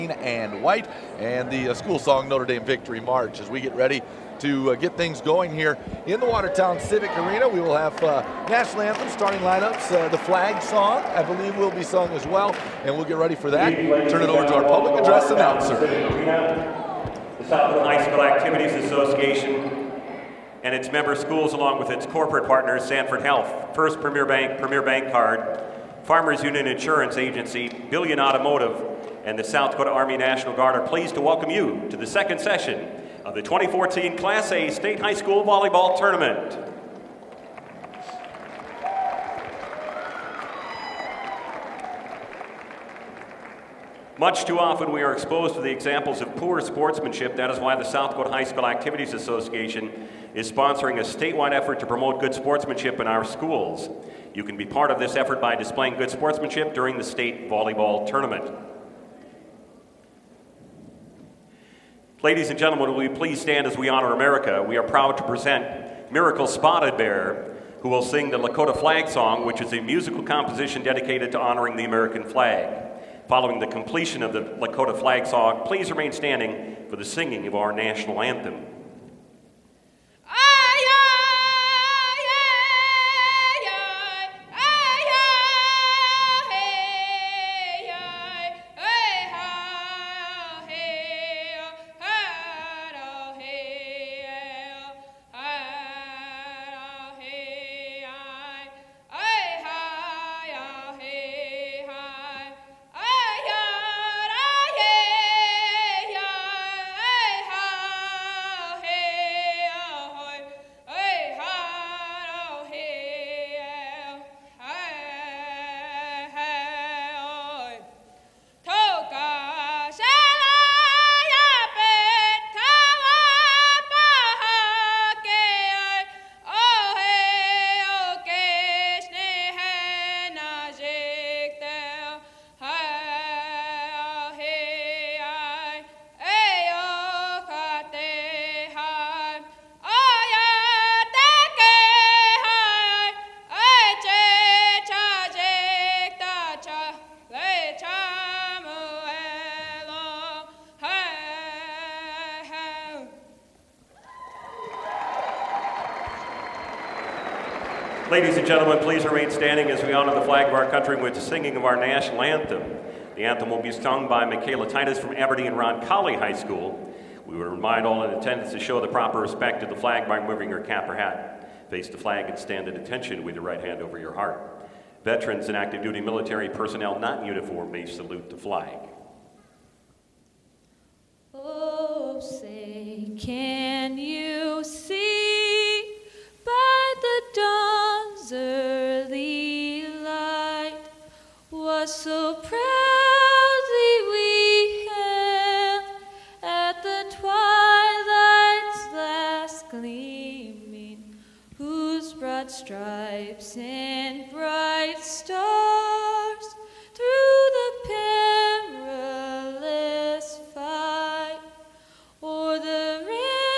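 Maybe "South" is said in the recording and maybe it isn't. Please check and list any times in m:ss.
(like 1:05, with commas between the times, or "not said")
0:17, 0:29, 0:47.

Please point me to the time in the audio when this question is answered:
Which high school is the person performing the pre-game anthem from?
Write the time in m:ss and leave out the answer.
2:45.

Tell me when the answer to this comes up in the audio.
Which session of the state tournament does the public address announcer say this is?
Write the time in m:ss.
0:32.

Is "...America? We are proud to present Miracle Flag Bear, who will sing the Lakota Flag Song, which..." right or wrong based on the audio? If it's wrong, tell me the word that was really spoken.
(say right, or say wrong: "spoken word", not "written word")
wrong: "Spotted", not "Flag".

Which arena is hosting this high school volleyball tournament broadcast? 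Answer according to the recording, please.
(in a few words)
Watertown Civic Arena.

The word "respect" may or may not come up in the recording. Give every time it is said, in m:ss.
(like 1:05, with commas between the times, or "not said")
2:49.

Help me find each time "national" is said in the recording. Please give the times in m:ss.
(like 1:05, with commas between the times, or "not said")
0:08, 0:30, 1:17, 2:41.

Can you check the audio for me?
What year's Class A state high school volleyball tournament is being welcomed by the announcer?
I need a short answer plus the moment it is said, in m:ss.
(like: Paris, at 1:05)
2014, at 0:33.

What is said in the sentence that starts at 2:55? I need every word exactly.
Veterans and active duty military personnel not in uniform may salute the flag.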